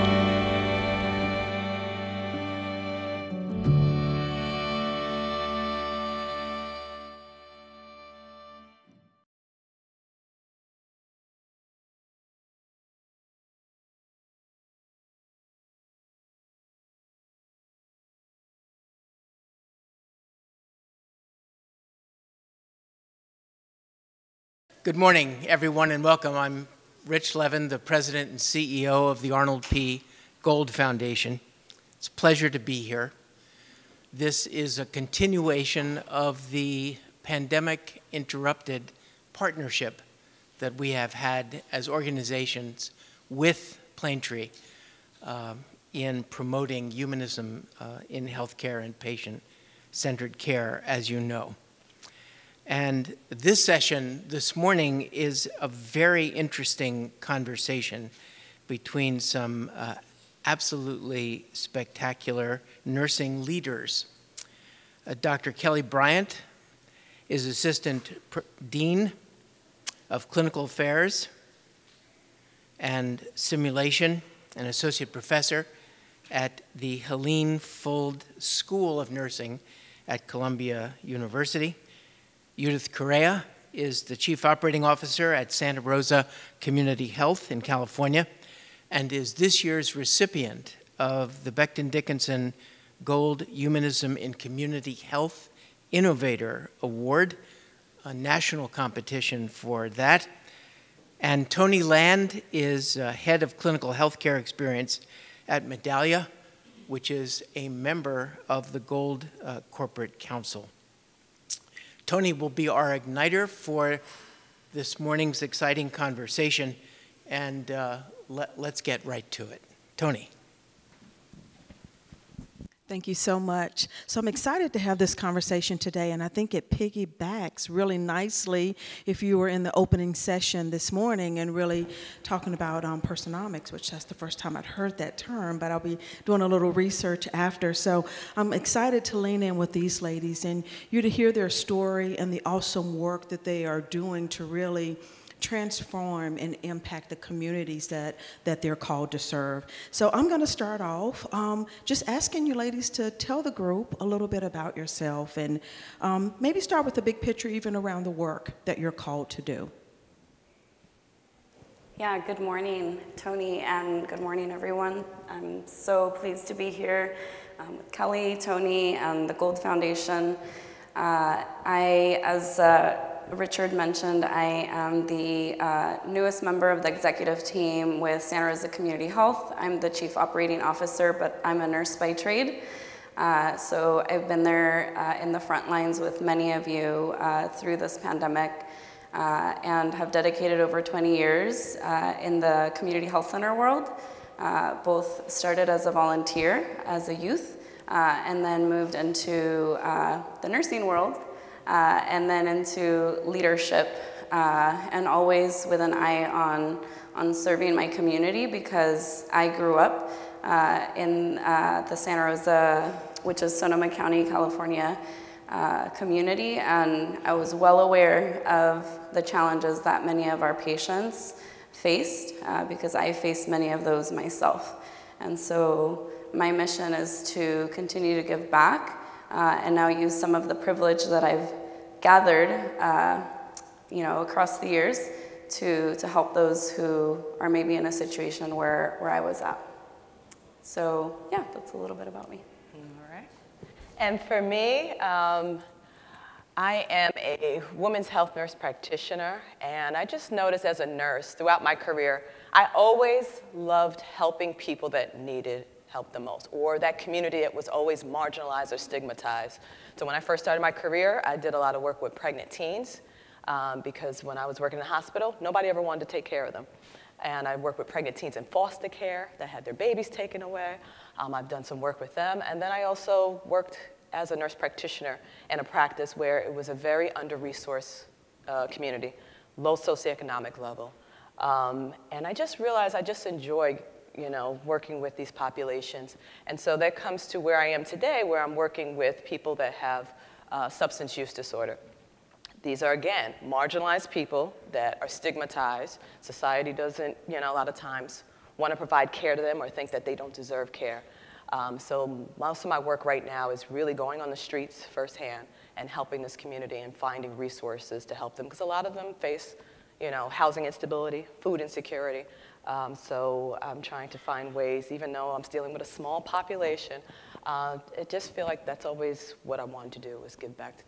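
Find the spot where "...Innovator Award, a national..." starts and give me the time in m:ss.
1:35.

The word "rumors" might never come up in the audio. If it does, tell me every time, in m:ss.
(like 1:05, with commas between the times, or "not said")
not said.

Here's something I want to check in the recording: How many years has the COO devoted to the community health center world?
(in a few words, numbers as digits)
over 20.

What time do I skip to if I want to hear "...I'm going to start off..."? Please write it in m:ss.
2:30.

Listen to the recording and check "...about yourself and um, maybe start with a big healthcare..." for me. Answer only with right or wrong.
wrong.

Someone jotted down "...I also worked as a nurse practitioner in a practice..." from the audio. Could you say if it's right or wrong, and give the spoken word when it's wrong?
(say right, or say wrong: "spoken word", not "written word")
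right.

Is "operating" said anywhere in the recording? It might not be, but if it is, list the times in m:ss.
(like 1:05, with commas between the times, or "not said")
1:24, 3:00.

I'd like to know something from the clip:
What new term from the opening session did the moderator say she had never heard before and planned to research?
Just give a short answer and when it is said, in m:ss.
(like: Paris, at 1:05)
personomics, at 2:13.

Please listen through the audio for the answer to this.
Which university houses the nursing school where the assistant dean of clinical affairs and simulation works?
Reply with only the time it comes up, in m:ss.
1:20.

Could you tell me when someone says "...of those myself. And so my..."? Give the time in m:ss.
3:43.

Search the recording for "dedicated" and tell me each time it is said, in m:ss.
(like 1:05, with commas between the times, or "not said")
3:10.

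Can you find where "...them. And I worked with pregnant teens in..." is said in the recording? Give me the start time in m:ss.
4:26.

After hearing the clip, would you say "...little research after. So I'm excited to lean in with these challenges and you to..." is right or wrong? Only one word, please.
wrong.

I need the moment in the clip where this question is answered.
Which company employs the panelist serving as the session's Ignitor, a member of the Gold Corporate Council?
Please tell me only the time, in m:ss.
1:45.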